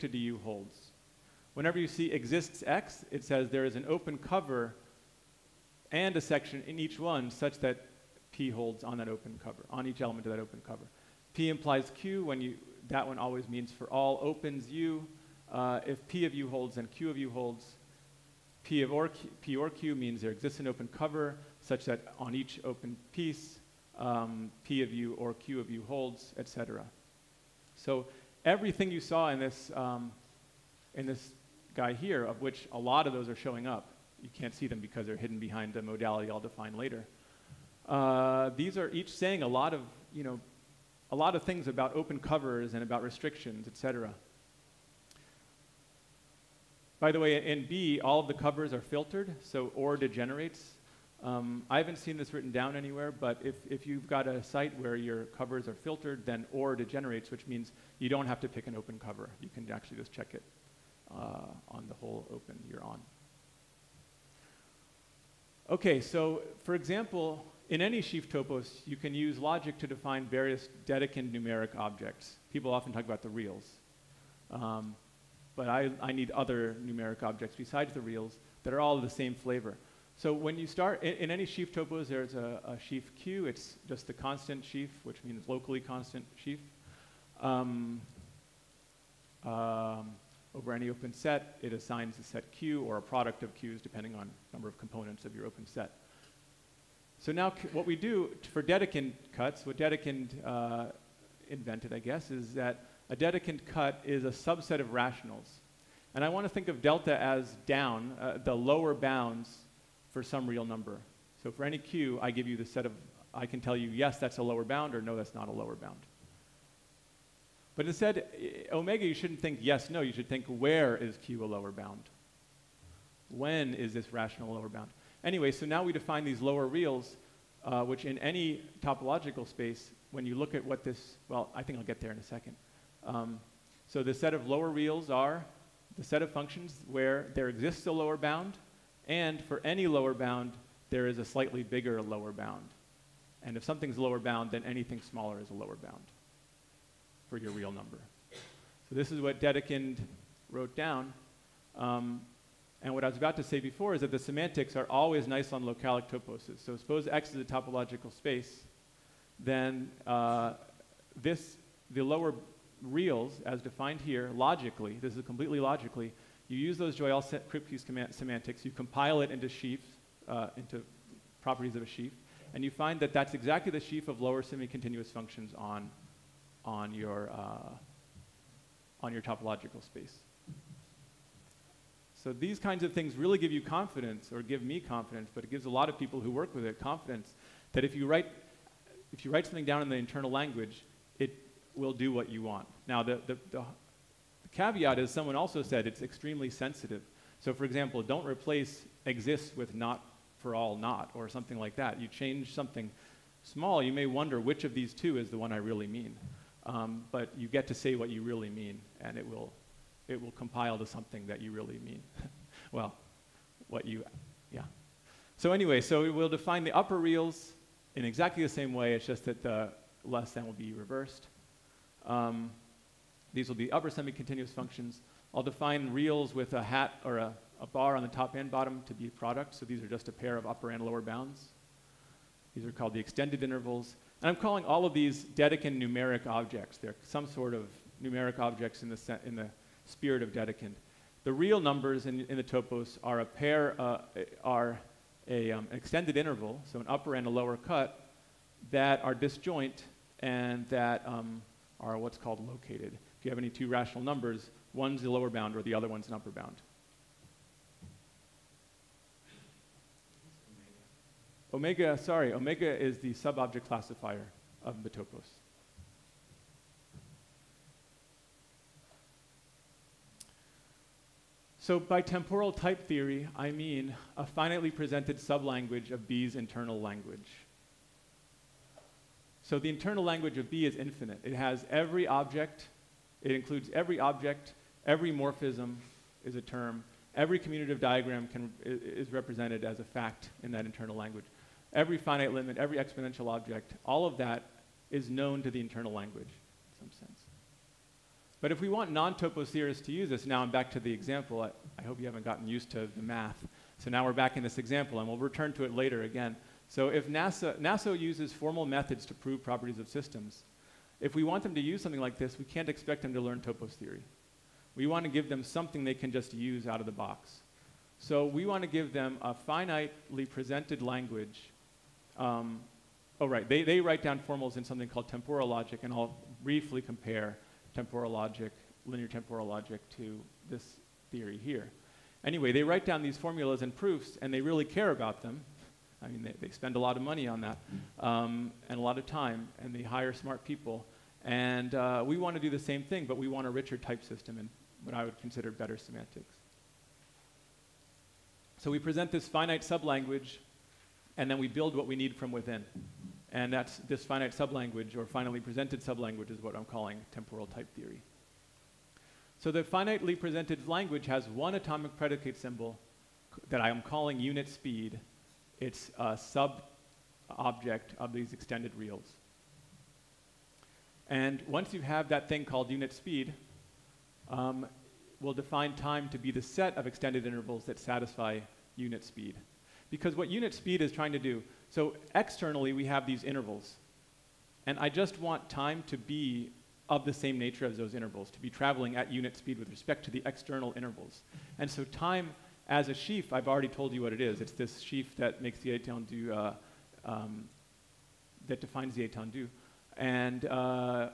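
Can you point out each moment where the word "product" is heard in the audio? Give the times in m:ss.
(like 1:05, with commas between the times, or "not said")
1:33, 3:49.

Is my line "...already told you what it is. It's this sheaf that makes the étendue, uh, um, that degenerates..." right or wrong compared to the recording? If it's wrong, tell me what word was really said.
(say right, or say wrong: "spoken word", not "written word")
wrong: "defines", not "degenerates".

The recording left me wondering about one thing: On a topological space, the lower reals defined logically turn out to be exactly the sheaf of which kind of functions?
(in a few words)
lower semi-continuous functions.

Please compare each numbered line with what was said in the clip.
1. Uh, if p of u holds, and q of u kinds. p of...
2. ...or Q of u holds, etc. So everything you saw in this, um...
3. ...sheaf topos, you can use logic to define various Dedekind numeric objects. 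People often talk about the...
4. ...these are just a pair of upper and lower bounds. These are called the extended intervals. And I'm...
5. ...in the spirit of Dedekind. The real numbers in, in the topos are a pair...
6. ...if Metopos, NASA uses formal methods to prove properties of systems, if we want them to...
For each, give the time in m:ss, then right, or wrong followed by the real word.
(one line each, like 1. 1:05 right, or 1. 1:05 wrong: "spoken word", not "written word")
1. 0:15 wrong: "holds", not "kinds"
2. 0:25 right
3. 1:07 right
4. 3:49 right
5. 3:59 right
6. 5:06 wrong: "NASA", not "Metopos".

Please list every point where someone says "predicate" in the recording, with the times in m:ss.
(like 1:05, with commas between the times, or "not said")
6:01.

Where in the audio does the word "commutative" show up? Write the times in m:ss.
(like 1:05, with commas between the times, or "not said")
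4:47.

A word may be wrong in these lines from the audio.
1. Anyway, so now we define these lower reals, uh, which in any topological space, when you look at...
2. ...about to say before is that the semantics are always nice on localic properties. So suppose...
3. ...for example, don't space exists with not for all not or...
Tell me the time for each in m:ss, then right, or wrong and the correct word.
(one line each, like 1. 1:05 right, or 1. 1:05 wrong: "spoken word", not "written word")
1. 2:05 right
2. 2:33 wrong: "toposes", not "properties"
3. 3:17 wrong: "replace", not "space".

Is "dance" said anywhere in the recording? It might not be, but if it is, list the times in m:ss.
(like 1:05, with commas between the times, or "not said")
not said.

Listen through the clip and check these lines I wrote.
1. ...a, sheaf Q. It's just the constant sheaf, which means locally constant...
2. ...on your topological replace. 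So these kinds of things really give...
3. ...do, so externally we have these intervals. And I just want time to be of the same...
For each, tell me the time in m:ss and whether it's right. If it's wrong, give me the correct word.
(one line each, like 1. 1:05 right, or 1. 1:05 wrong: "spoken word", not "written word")
1. 1:22 right
2. 2:59 wrong: "space", not "replace"
3. 6:21 right.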